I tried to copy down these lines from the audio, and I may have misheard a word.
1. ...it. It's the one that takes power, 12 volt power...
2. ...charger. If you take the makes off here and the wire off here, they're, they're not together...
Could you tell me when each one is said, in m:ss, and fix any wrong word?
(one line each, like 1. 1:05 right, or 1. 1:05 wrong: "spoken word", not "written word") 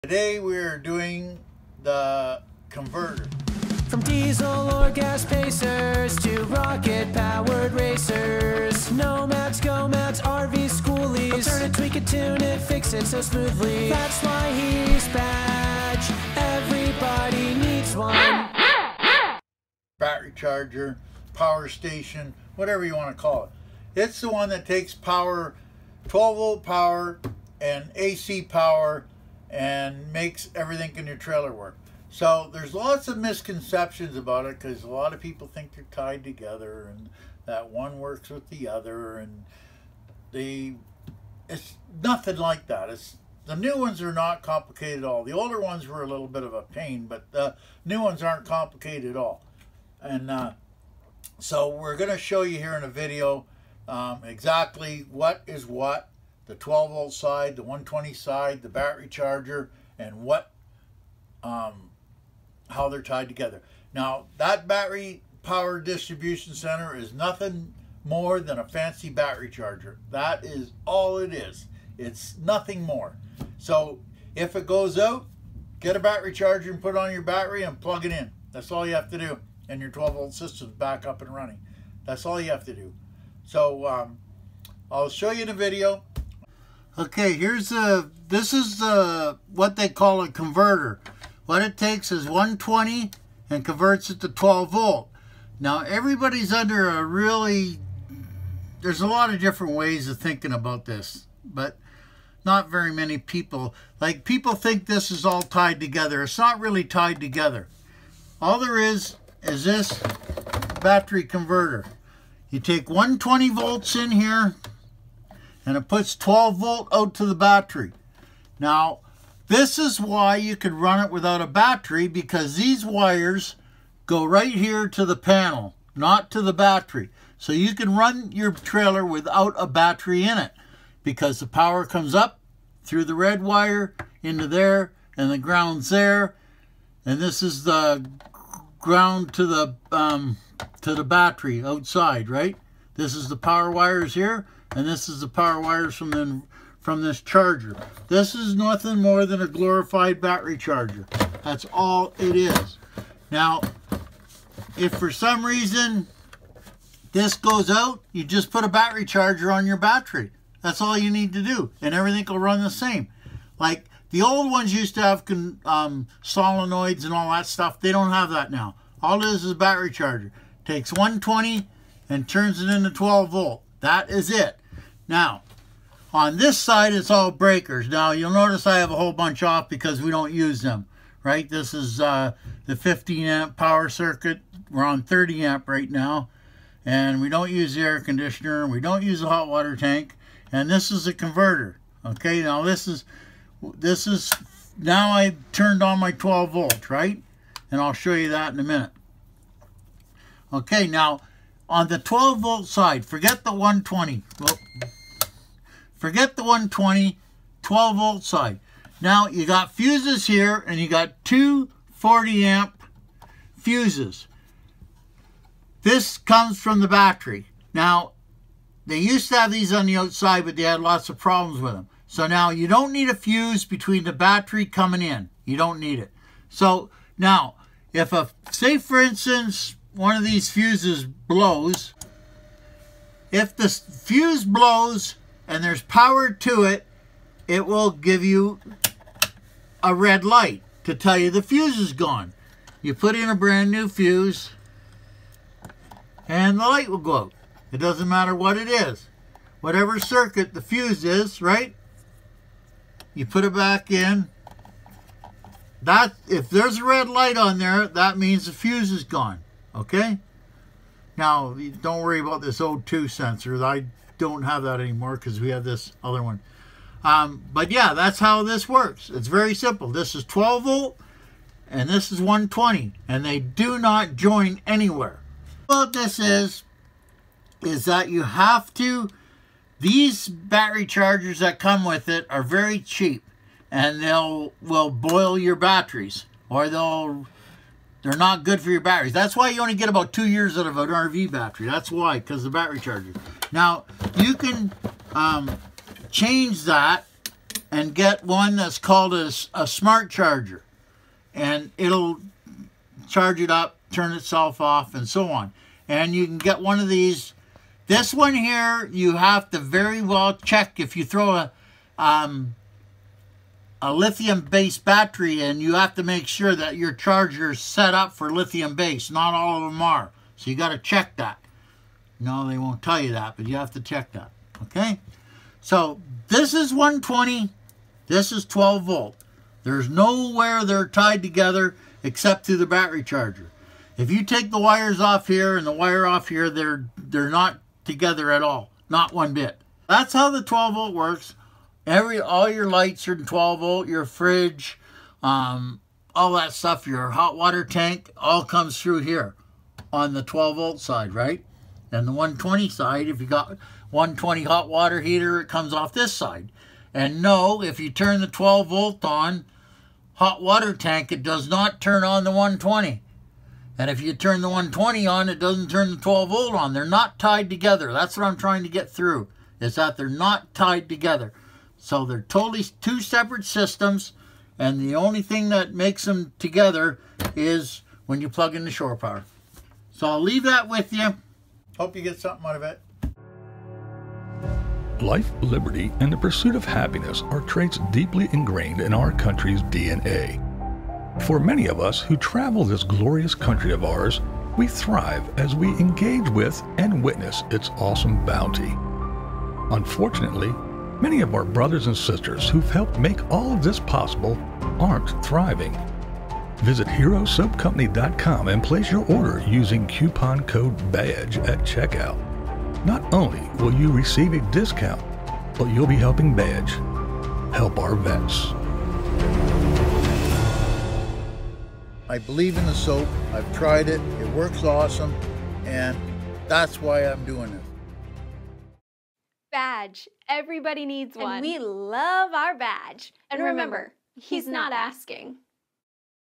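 1. 0:23 right
2. 5:33 wrong: "wires", not "makes".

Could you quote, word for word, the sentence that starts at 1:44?
Like people think this is all tied together.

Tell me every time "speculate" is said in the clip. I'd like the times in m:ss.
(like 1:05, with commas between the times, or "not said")
not said.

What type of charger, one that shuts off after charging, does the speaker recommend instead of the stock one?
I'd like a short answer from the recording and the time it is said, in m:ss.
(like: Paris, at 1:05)
Smart charger, at 4:59.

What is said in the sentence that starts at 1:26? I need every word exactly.
Okay, here's a, this is a, what they call a converter.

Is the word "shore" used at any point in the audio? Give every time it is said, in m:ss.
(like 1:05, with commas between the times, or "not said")
6:18.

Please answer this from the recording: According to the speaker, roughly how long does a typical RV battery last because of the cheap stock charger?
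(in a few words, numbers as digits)
About two years.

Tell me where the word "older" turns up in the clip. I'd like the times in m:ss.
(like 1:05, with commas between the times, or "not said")
0:45.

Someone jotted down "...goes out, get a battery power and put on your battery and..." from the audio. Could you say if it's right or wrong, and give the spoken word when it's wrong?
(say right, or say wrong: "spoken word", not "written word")
wrong: "charger", not "power".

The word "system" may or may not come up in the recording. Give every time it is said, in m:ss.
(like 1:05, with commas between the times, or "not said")
1:20, 6:13.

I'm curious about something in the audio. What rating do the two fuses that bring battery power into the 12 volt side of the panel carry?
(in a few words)
40 amp.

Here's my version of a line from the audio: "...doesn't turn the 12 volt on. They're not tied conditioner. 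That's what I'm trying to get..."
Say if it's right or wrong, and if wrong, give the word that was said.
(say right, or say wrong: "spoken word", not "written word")
wrong: "together", not "conditioner".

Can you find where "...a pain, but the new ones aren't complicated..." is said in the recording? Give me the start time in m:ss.
0:46.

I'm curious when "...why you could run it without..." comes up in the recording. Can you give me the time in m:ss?
2:00.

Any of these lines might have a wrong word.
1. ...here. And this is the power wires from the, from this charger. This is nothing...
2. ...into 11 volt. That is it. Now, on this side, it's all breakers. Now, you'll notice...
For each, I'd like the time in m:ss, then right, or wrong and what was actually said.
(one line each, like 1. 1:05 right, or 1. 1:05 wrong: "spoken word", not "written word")
1. 2:24 right
2. 2:52 wrong: "12", not "11".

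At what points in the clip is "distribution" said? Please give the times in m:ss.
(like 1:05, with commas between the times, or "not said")
1:05.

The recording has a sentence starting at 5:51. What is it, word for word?
And the 120 side, if you got 120 hot water heater, it comes off this side.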